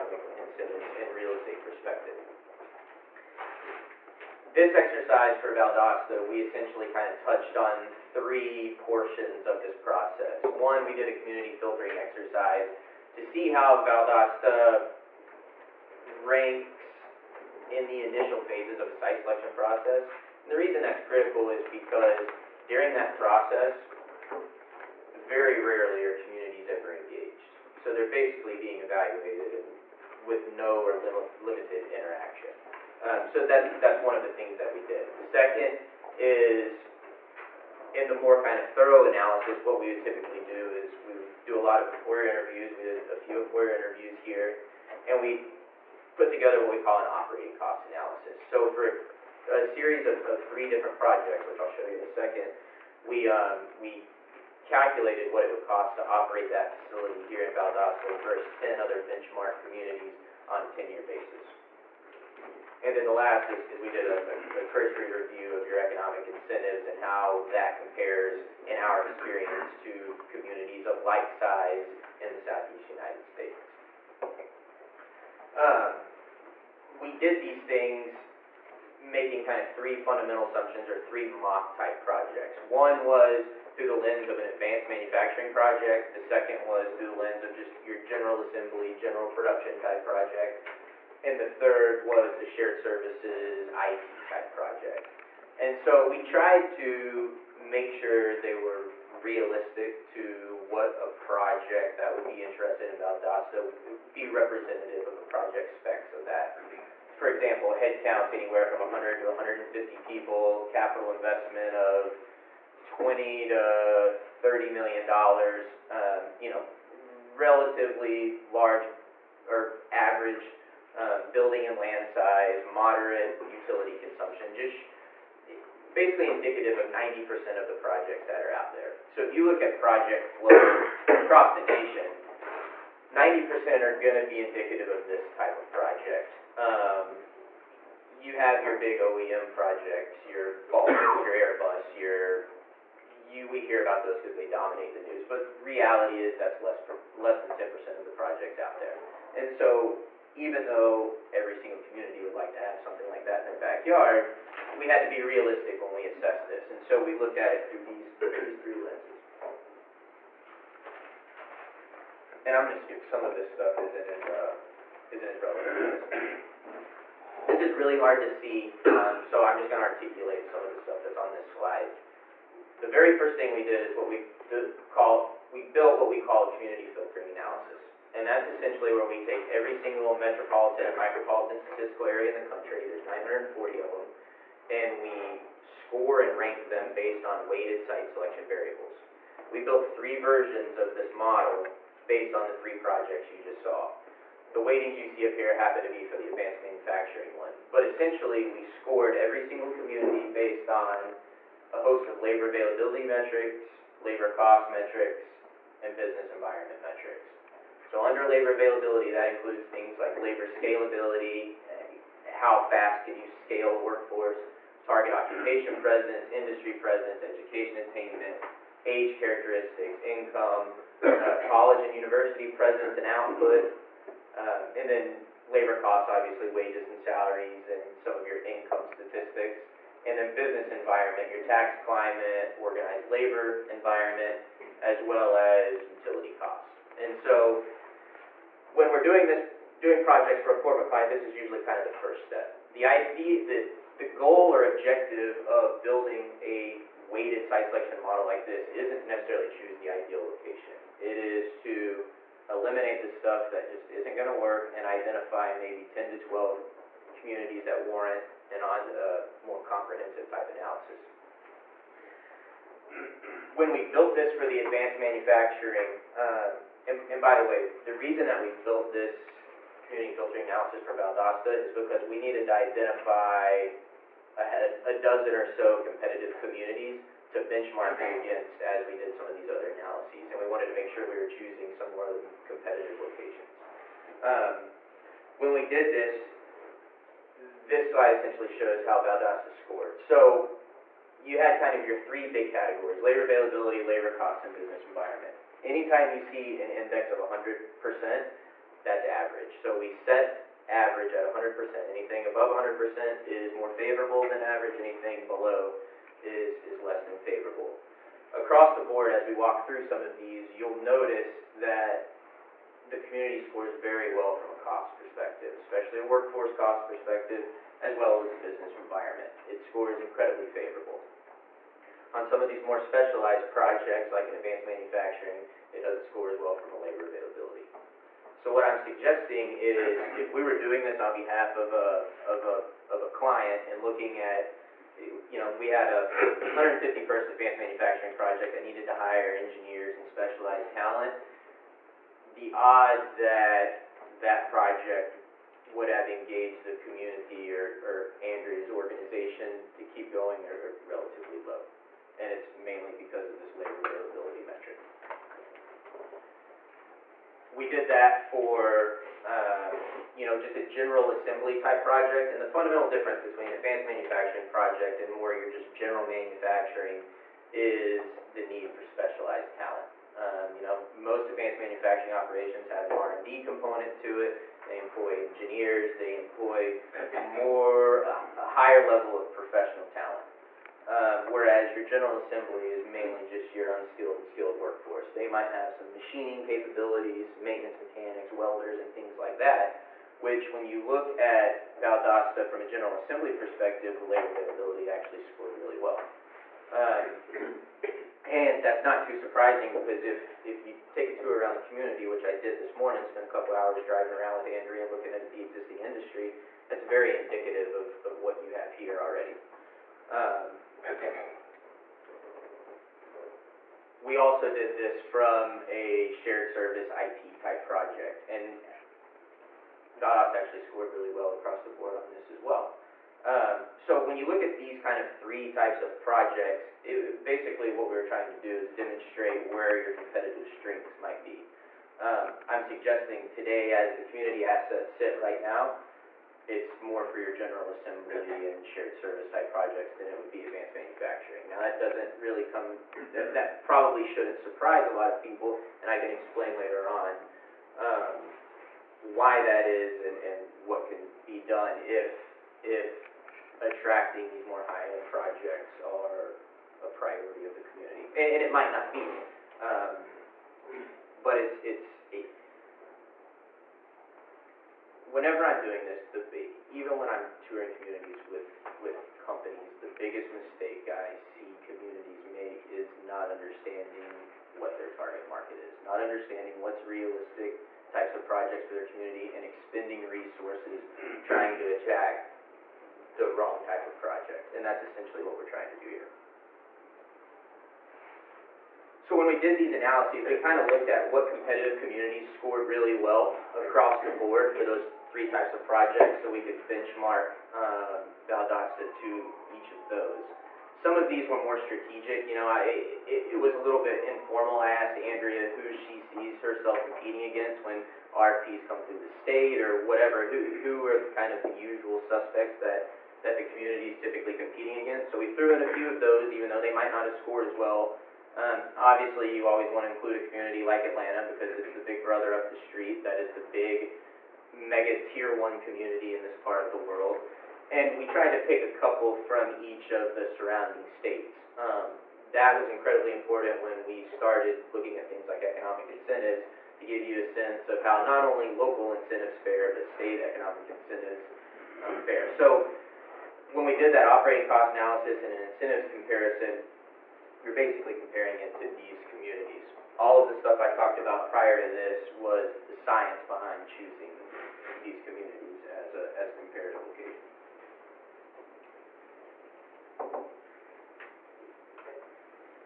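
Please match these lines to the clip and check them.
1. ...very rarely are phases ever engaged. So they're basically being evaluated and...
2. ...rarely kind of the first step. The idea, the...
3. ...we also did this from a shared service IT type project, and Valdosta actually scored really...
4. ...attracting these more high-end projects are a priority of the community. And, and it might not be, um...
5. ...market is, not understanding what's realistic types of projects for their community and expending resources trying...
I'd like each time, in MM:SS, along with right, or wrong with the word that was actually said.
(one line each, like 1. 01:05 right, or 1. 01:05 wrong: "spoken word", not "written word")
1. 00:25 wrong: "communities", not "phases"
2. 04:01 wrong: "usually", not "rarely"
3. 06:54 right
4. 07:33 right
5. 07:55 right.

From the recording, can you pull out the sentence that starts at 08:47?
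And we tried to pick a couple from each of the surrounding states.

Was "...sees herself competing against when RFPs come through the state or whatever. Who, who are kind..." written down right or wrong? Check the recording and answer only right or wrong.
right.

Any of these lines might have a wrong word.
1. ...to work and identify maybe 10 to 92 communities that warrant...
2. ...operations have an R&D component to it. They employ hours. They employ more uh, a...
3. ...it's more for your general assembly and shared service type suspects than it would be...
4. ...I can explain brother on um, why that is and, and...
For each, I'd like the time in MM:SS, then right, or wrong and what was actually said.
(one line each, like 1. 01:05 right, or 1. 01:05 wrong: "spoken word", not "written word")
1. 04:14 wrong: "12", not "92"
2. 06:12 wrong: "engineers", not "hours"
3. 07:16 wrong: "projects", not "suspects"
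4. 07:25 wrong: "later", not "brother".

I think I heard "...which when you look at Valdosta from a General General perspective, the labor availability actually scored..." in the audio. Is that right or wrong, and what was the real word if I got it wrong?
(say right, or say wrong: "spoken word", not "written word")
wrong: "Assembly", not "General".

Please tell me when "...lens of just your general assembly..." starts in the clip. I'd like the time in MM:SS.
01:27.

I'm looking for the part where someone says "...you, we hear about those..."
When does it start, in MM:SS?
02:23.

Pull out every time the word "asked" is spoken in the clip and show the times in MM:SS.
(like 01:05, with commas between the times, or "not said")
08:24.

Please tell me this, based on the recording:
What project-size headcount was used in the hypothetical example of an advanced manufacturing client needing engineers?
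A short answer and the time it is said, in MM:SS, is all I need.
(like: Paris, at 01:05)
150, at 05:36.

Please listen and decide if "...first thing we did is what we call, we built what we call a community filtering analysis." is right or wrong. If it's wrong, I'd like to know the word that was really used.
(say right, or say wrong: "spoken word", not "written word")
right.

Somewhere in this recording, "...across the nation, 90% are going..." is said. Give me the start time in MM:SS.
02:11.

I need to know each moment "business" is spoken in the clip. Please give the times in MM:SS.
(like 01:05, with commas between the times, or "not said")
03:25, 03:50, 04:54, 05:18.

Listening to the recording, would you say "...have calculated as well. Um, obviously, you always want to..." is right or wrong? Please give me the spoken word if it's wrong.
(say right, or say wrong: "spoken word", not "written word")
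wrong: "scored", not "calculated".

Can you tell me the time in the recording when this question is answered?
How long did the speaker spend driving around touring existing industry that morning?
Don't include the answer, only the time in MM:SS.
06:43.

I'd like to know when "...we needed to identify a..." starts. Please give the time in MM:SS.
04:32.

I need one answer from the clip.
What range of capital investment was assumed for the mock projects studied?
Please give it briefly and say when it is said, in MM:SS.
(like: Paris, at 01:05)
20 to 30 million dollars, at 01:52.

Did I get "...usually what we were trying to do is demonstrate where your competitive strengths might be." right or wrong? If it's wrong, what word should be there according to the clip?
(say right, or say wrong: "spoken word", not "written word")
wrong: "basically", not "usually".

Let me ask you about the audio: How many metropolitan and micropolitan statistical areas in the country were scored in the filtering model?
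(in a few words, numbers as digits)
940.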